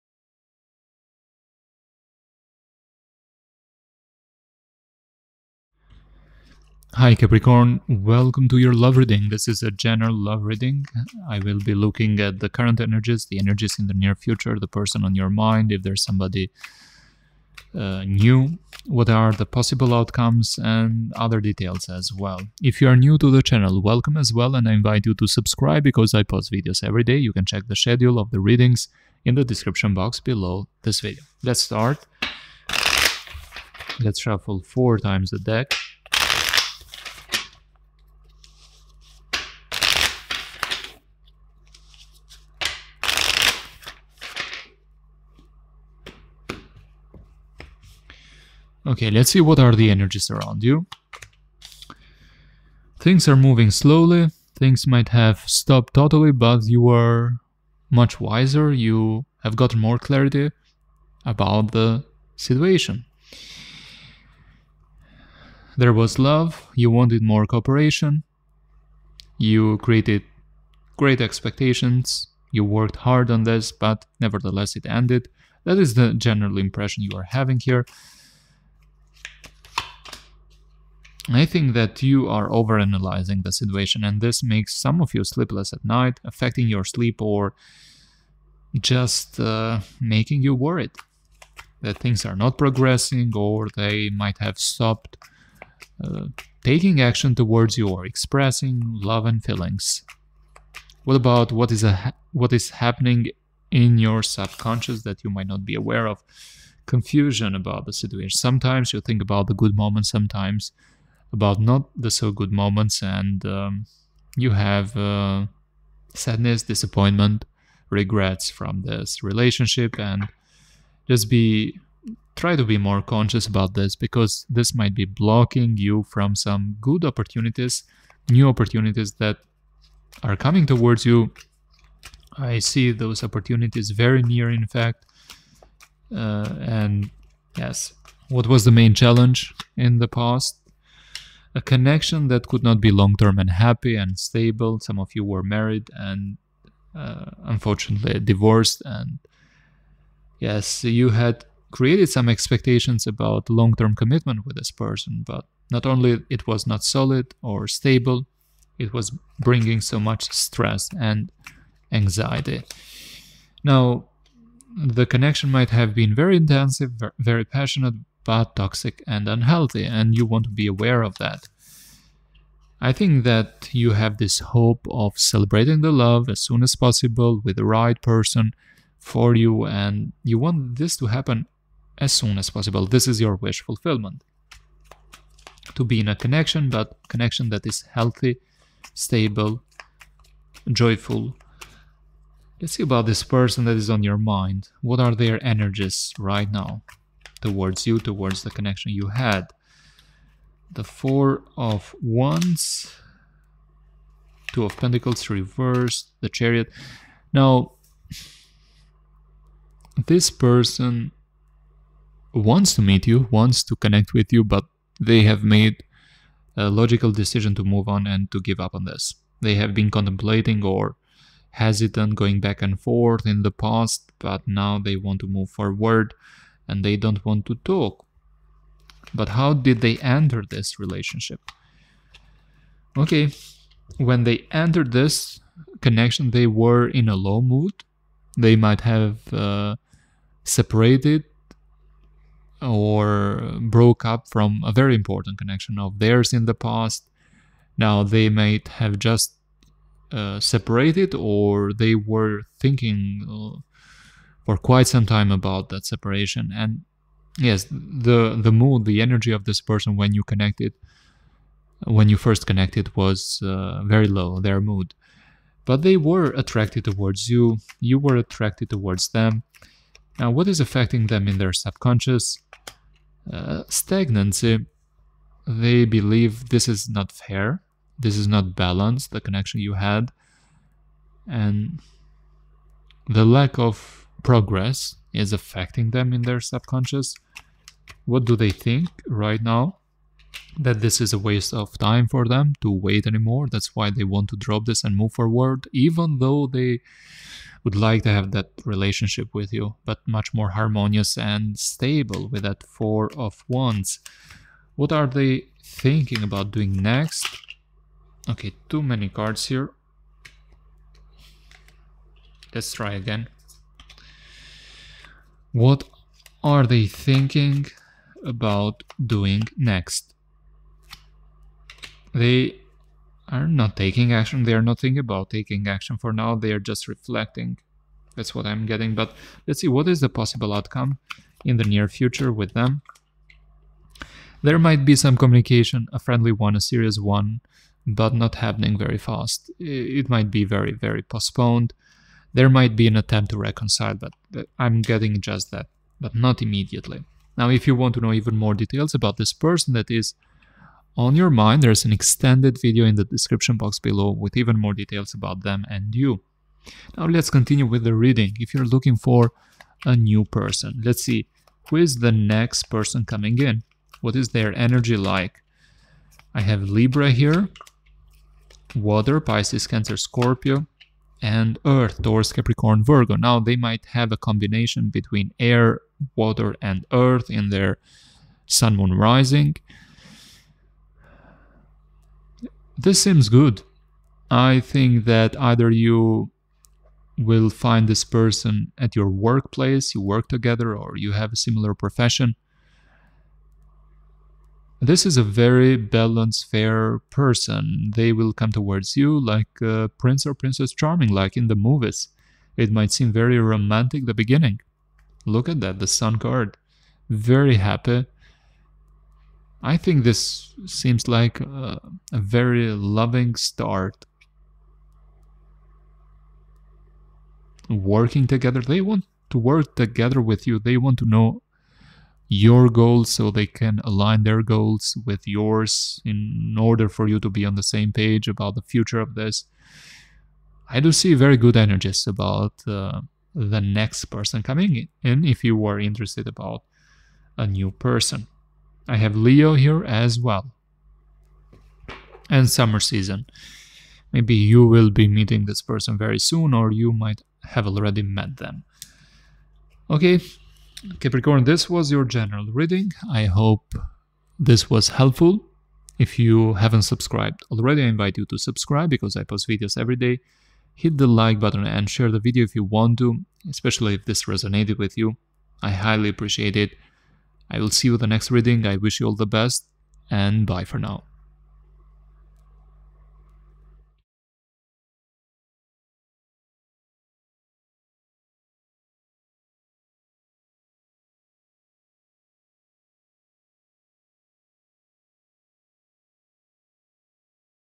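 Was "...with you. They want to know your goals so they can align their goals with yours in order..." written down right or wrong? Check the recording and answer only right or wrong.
right.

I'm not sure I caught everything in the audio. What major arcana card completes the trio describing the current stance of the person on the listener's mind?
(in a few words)
The Chariot.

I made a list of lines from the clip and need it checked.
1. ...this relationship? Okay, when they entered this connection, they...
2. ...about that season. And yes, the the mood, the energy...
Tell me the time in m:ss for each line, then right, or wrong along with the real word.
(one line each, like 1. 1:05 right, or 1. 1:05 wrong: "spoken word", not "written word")
1. 3:50 right
2. 4:15 wrong: "separation", not "season".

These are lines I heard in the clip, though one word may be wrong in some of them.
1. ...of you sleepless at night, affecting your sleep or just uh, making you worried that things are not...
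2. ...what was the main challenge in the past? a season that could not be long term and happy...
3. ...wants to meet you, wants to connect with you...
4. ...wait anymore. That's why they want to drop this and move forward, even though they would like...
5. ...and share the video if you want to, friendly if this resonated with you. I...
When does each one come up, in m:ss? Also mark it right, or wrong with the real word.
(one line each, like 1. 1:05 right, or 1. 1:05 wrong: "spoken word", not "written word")
1. 1:25 right
2. 2:18 wrong: "connection", not "season"
3. 3:32 right
4. 4:52 right
5. 7:41 wrong: "especially", not "friendly".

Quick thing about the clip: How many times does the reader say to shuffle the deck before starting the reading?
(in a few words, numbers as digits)
4.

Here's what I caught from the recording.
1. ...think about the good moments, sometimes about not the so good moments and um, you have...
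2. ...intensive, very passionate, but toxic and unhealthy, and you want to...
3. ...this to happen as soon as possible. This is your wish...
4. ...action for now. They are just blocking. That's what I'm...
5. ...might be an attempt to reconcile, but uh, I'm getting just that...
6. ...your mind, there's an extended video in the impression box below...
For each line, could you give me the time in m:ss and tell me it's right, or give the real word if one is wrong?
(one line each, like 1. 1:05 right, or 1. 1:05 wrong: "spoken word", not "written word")
1. 1:49 right
2. 2:46 right
3. 3:00 right
4. 5:25 wrong: "reflecting", not "blocking"
5. 5:42 right
6. 5:51 wrong: "description", not "impression".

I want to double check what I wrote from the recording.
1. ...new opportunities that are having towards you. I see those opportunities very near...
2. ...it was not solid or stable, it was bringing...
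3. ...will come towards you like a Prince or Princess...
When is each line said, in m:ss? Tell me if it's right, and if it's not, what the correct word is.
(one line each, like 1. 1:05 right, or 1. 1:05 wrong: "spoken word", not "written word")
1. 2:08 wrong: "coming", not "having"
2. 2:36 right
3. 6:38 right.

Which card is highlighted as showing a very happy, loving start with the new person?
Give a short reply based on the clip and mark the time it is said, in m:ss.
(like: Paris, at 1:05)
The Sun, at 6:45.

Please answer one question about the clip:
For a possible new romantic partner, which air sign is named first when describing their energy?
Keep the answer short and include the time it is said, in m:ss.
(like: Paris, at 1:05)
Libra, at 6:06.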